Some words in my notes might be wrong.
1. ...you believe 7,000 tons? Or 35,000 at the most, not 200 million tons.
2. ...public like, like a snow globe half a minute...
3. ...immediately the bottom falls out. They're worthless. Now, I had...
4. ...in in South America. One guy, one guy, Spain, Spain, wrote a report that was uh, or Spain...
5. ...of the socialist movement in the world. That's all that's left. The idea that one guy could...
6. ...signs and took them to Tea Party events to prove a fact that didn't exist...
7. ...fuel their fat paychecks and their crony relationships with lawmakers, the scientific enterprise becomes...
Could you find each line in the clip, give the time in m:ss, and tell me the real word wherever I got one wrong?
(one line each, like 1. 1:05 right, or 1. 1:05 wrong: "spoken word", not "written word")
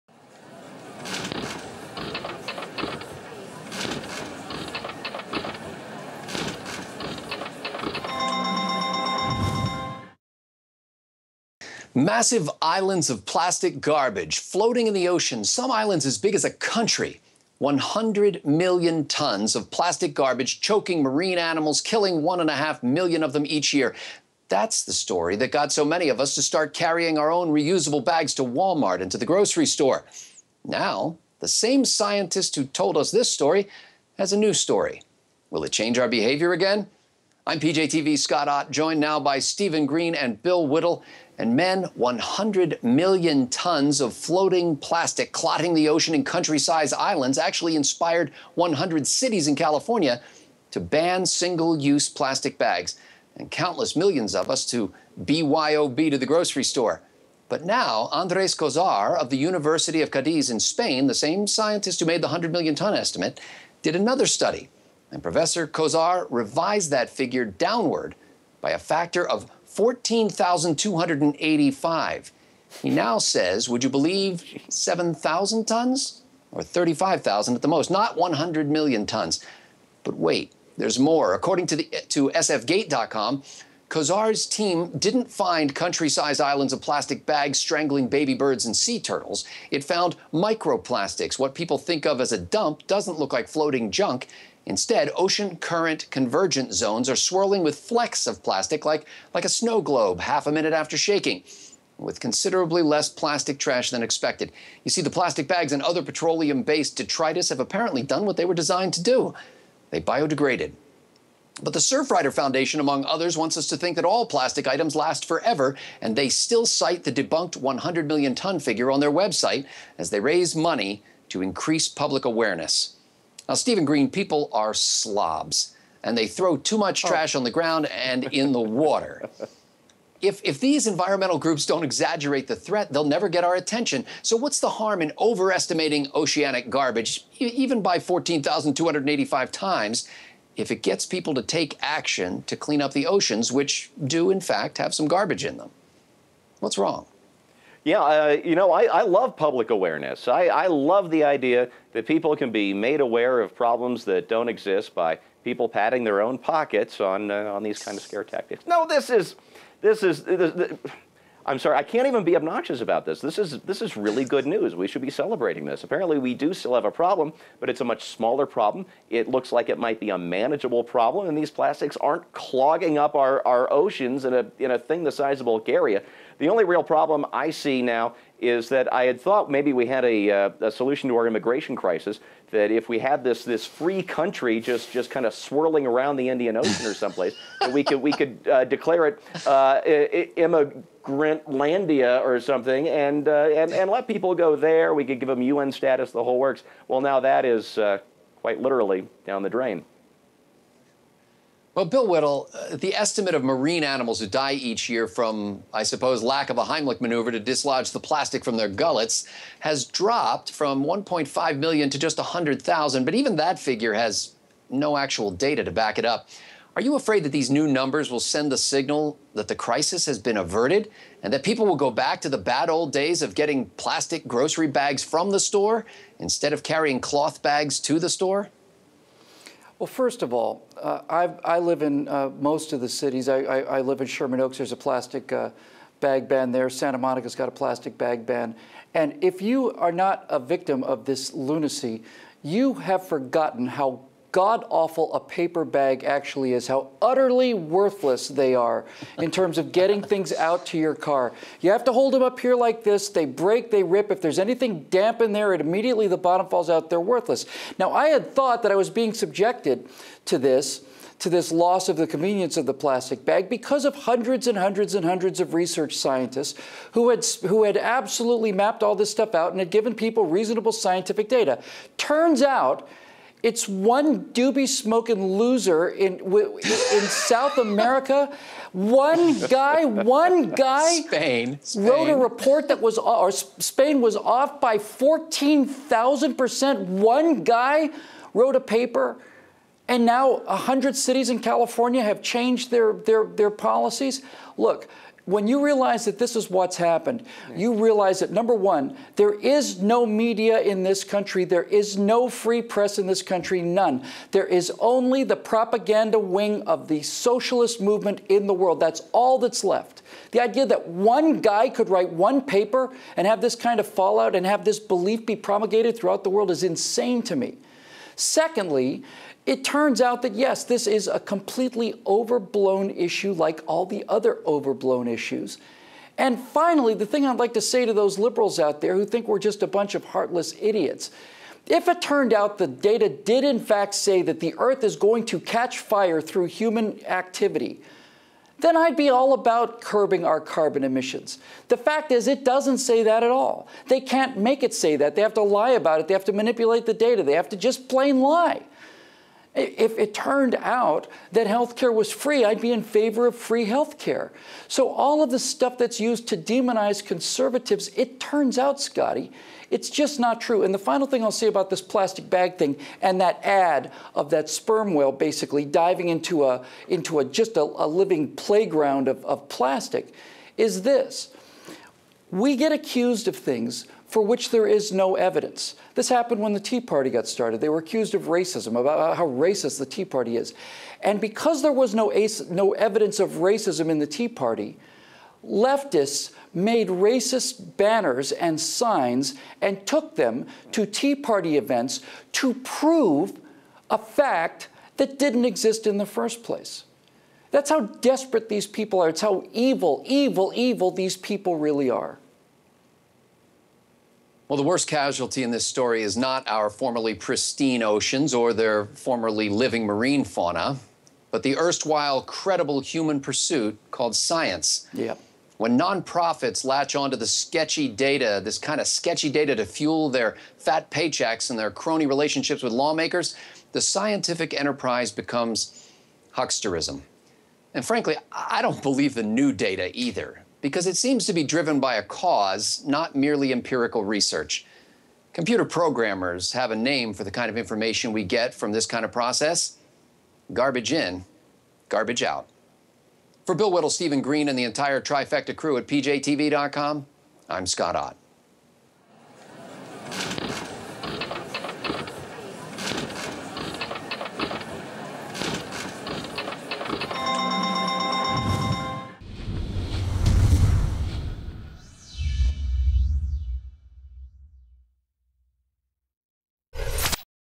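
1. 1:13 wrong: "100", not "200"
2. 1:38 wrong: "plastic", not "public"
3. 4:15 right
4. 4:35 right
5. 5:06 right
6. 6:28 right
7. 6:59 right.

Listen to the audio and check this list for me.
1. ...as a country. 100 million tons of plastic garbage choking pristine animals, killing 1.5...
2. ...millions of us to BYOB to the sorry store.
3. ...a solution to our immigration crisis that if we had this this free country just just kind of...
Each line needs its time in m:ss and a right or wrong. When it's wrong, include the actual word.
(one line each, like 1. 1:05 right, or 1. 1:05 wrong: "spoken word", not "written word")
1. 0:16 wrong: "marine", not "pristine"
2. 0:53 wrong: "grocery", not "sorry"
3. 3:00 right.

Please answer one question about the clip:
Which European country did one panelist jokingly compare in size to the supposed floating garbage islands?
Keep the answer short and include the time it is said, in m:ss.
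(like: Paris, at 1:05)
Bulgaria, at 2:55.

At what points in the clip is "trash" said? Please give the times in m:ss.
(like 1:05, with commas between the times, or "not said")
1:43, 2:07.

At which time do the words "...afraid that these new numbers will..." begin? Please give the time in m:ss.
3:36.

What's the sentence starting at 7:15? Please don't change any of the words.
Computer programmers have a name for the kind of information we get from this kind of process garbage in, garbage out.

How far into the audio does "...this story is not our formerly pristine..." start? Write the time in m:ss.
6:45.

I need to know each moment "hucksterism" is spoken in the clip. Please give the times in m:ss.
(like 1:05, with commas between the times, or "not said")
7:06.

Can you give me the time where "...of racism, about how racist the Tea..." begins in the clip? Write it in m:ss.
6:18.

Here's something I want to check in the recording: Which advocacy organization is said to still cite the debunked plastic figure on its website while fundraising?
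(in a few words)
Surfrider Foundation.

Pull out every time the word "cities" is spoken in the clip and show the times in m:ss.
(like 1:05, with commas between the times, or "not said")
0:49, 3:52, 4:50.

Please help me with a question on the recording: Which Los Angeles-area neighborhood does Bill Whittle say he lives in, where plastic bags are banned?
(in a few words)
Sherman Oaks.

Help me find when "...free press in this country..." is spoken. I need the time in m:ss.
5:02.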